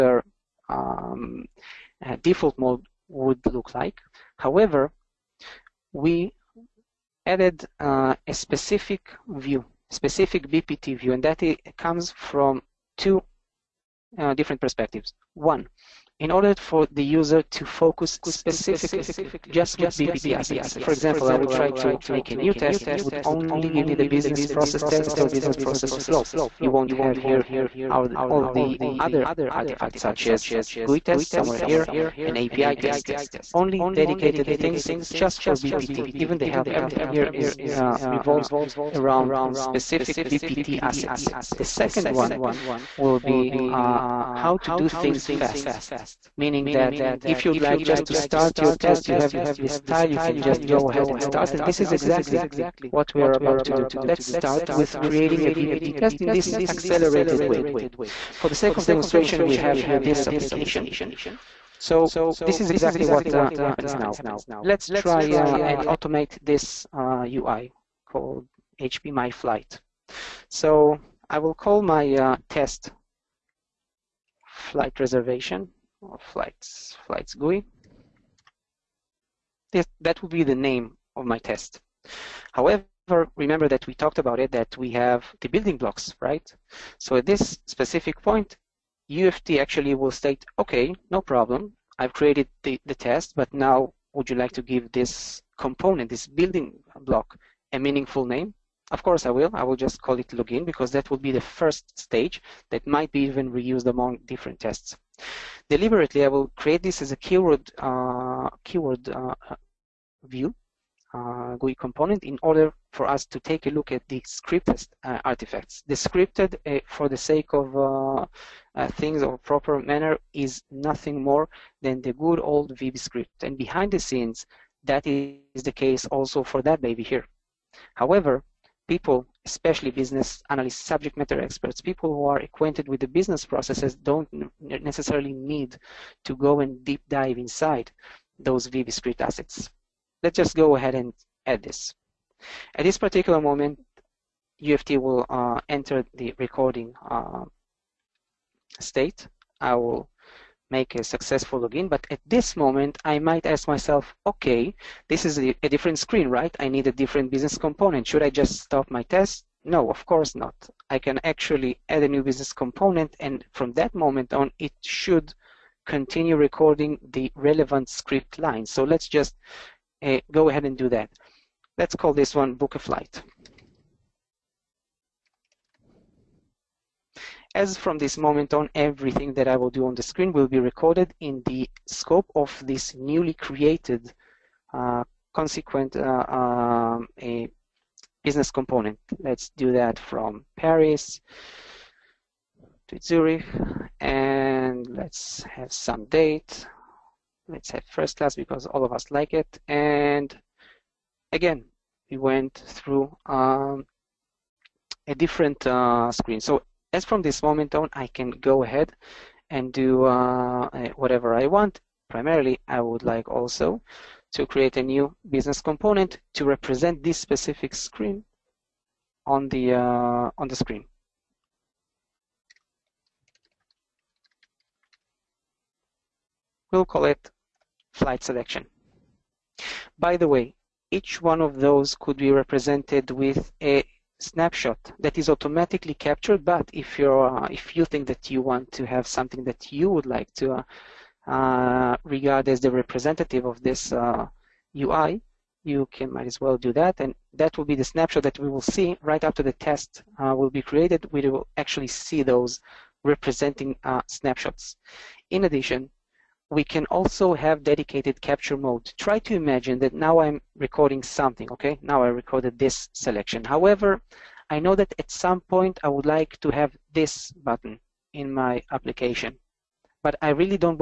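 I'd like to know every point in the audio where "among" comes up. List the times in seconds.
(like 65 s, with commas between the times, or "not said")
103 s.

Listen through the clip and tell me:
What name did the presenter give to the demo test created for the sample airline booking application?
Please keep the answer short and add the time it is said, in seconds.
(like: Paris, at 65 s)
flights GUI, at 76 s.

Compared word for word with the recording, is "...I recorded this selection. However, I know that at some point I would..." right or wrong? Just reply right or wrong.
right.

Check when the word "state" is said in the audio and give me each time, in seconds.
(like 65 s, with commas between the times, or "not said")
90 s, 148 s.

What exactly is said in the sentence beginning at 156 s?
I need a different business component.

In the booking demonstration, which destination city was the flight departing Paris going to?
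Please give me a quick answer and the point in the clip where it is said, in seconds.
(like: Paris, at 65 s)
Zurich, at 193 s.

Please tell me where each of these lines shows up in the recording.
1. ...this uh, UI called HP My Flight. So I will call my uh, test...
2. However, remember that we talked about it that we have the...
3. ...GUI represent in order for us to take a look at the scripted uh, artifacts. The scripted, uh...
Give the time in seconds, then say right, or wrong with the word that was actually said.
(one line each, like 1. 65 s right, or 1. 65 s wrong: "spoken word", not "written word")
1. 66 s right
2. 82 s right
3. 111 s wrong: "component", not "represent".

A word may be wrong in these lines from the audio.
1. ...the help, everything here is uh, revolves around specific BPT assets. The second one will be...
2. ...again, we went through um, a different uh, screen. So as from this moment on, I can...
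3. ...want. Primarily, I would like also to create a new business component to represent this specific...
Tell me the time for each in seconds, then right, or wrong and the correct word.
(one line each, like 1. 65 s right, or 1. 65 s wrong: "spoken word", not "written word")
1. 36 s right
2. 201 s right
3. 211 s right.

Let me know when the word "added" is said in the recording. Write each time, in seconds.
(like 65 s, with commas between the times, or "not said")
7 s.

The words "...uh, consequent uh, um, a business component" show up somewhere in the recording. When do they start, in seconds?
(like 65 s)
184 s.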